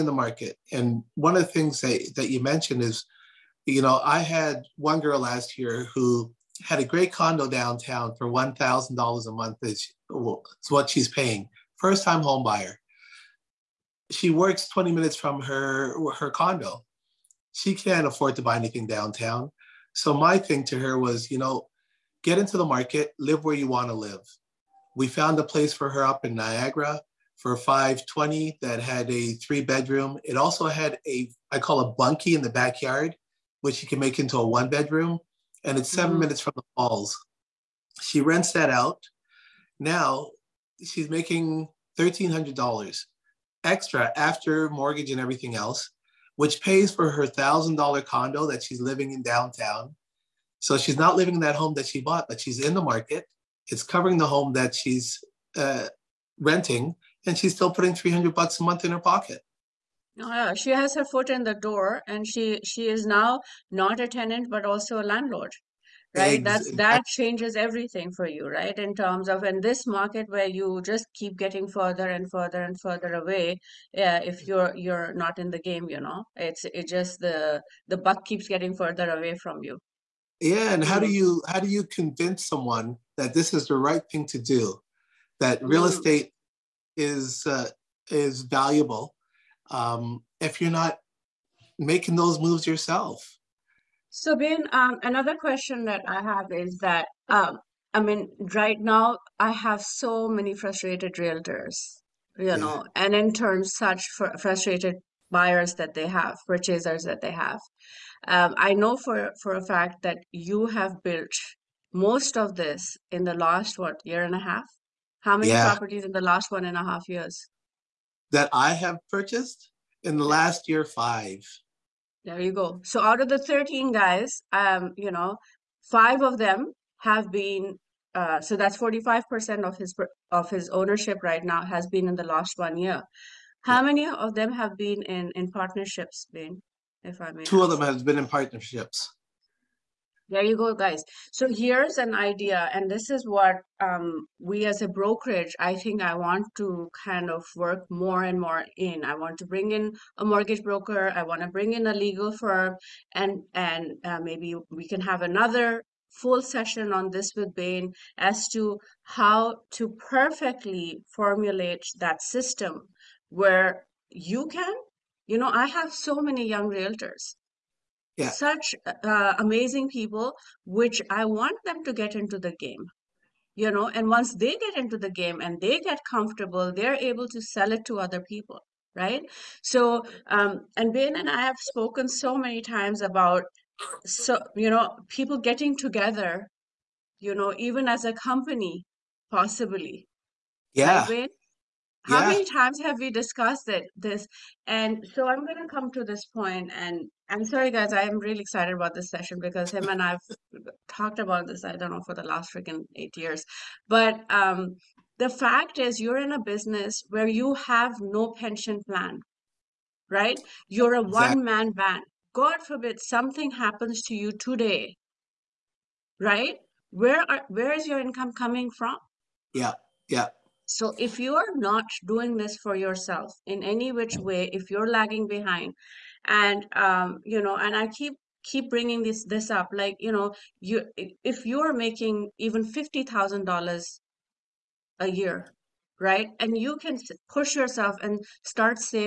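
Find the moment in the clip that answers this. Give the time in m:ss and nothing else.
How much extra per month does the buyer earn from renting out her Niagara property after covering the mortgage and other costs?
0:41.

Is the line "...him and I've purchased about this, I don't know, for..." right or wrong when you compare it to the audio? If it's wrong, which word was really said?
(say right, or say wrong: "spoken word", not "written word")
wrong: "talked", not "purchased".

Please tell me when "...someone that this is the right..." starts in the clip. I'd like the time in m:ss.
1:22.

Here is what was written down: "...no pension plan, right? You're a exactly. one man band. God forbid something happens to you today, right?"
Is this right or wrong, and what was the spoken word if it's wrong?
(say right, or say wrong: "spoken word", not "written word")
right.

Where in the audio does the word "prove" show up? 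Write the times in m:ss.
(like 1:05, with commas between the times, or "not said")
not said.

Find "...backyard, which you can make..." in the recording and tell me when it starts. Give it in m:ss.
0:32.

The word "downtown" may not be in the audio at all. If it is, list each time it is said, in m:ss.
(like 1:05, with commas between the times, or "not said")
0:07, 0:18, 0:49.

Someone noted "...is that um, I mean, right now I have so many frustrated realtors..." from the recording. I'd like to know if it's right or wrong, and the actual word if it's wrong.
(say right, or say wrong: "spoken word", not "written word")
right.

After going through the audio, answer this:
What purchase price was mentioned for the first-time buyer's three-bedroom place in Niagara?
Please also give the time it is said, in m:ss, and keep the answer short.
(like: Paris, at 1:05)
520, at 0:27.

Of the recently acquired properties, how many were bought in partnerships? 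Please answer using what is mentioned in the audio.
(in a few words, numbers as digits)
2.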